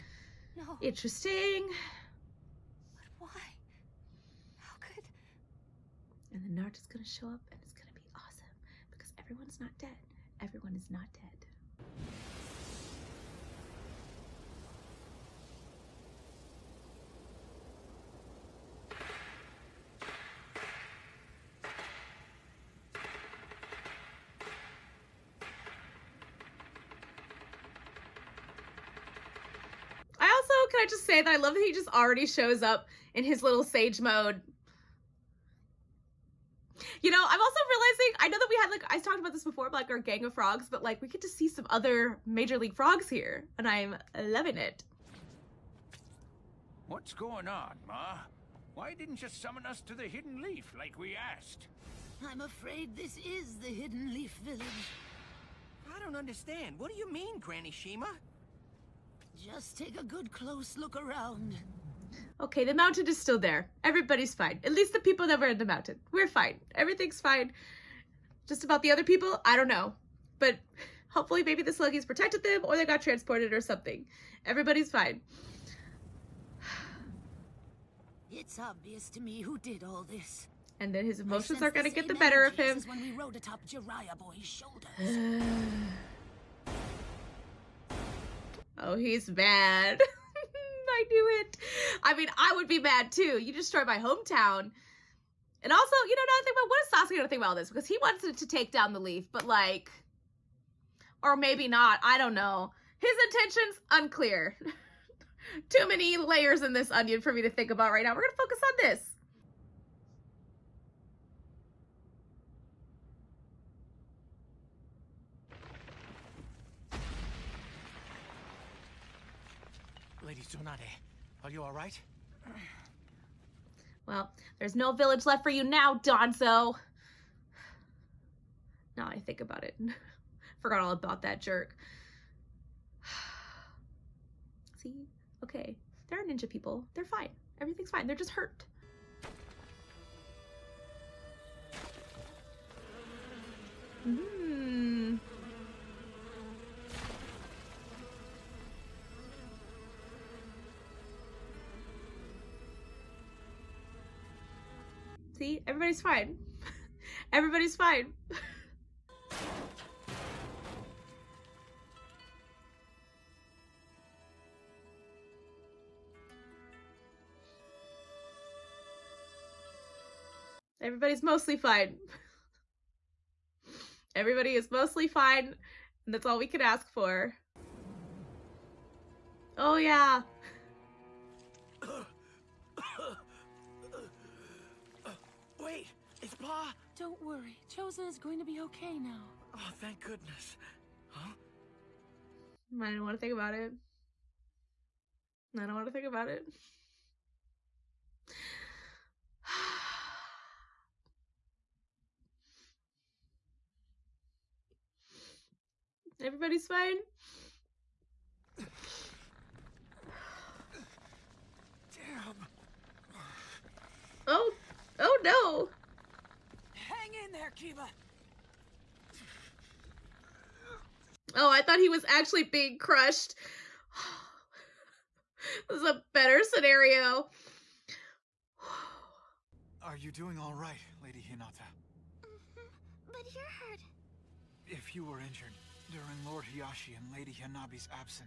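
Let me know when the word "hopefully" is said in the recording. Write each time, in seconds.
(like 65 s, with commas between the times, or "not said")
71 s.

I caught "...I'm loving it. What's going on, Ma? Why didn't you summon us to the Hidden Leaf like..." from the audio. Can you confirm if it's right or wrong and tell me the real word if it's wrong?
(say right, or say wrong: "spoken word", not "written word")
right.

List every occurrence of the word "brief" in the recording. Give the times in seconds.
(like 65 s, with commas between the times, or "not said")
not said.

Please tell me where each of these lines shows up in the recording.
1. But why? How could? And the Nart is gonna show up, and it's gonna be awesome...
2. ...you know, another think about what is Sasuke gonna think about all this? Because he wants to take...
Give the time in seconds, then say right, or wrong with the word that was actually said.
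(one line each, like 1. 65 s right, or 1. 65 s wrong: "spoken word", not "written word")
1. 3 s right
2. 96 s right.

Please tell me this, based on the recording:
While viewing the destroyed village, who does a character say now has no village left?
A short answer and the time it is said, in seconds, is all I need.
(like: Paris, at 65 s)
Danzo, at 126 s.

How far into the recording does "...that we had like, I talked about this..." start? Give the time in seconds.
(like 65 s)
38 s.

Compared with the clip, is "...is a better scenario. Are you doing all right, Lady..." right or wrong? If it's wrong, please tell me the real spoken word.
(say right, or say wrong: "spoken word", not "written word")
right.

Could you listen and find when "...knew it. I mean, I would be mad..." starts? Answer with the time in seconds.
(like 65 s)
91 s.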